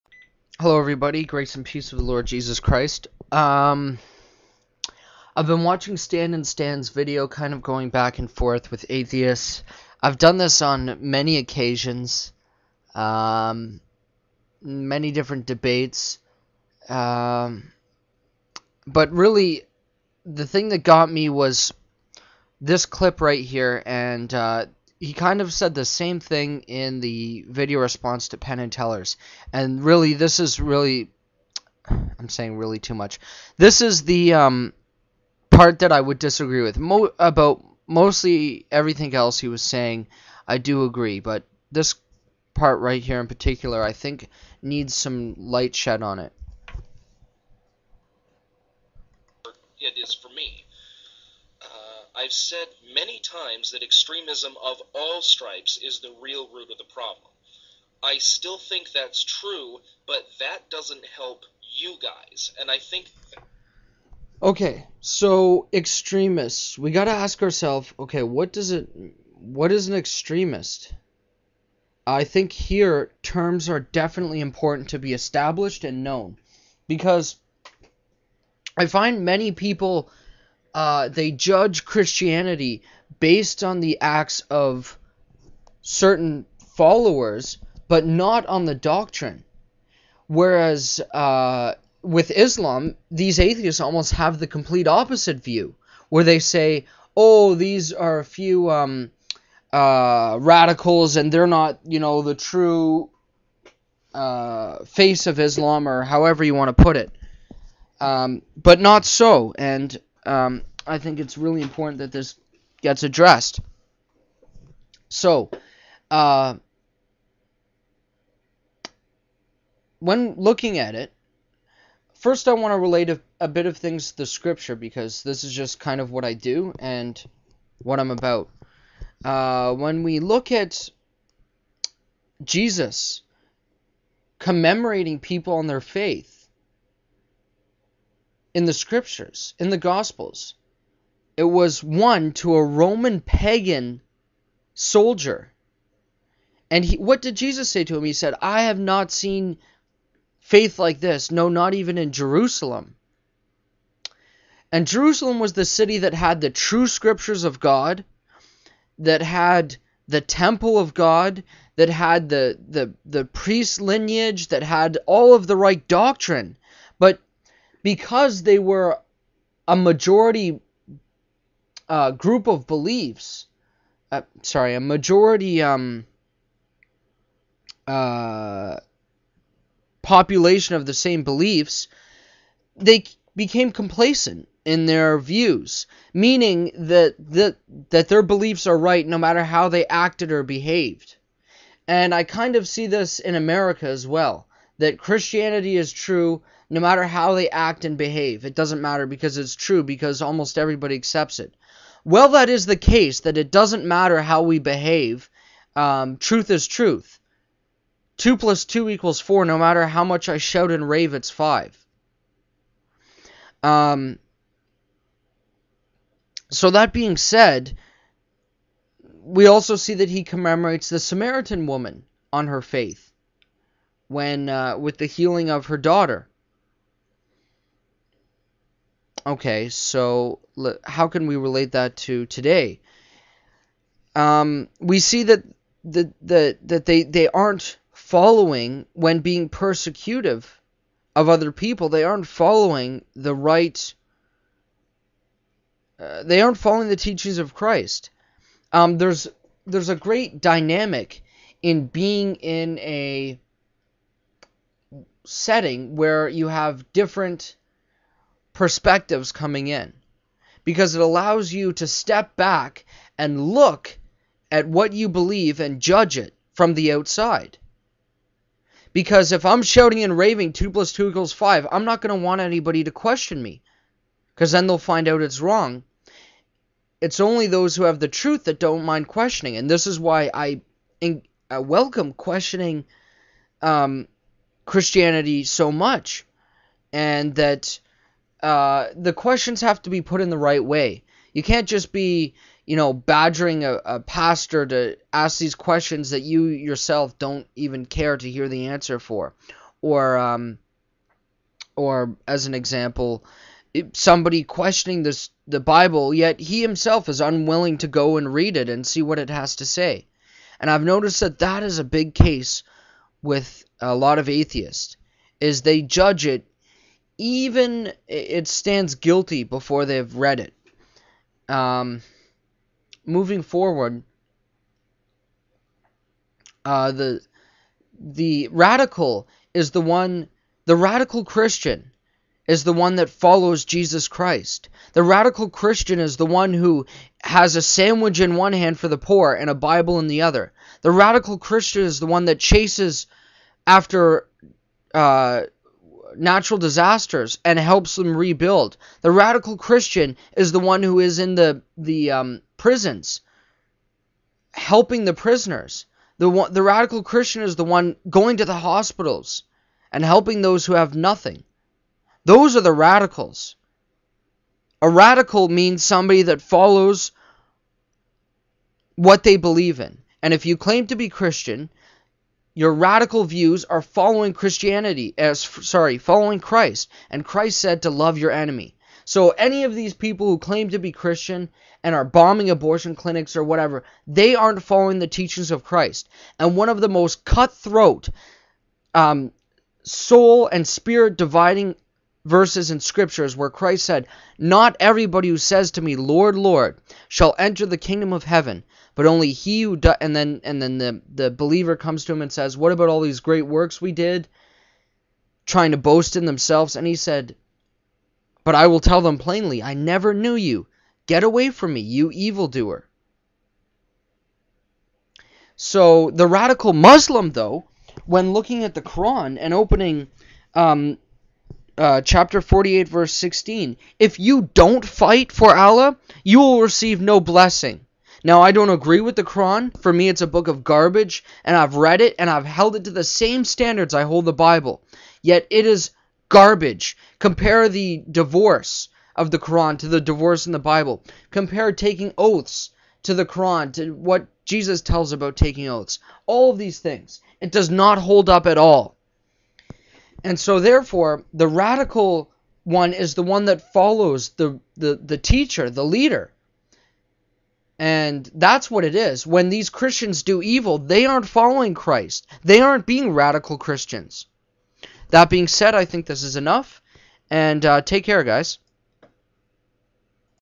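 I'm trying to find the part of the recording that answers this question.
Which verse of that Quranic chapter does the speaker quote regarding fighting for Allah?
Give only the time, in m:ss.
7:02.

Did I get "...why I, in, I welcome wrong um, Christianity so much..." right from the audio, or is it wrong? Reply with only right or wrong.
wrong.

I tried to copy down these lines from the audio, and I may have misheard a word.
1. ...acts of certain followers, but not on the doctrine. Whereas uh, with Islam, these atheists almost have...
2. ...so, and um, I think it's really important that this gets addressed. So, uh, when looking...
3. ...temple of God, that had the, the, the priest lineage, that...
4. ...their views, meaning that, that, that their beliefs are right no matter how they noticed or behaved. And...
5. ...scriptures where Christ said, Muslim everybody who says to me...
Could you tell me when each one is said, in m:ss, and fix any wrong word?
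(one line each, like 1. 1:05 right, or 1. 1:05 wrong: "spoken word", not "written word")
1. 1:24 right
2. 1:49 right
3. 2:40 right
4. 3:04 wrong: "acted", not "noticed"
5. 6:32 wrong: "Not", not "Muslim".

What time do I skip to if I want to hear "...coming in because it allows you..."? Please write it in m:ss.
4:19.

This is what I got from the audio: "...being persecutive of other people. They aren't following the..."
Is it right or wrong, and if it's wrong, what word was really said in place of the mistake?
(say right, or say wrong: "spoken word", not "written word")
right.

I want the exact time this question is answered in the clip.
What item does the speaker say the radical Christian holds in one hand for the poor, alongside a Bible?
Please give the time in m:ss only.
5:37.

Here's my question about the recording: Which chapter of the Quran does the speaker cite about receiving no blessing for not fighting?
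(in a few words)
48.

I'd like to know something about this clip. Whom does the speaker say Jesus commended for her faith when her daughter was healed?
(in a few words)
Samaritan woman.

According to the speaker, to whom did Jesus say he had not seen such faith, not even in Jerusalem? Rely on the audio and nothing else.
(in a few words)
Roman pagan soldier.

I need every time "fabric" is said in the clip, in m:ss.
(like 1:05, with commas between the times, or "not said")
not said.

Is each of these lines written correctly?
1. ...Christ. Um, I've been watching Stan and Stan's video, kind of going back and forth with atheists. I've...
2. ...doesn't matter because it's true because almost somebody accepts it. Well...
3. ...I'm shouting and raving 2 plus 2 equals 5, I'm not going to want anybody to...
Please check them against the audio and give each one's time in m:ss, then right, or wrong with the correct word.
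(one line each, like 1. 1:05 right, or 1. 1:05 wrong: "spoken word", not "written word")
1. 0:02 right
2. 3:18 wrong: "everybody", not "somebody"
3. 4:29 right.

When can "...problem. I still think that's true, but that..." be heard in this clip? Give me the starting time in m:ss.
0:56.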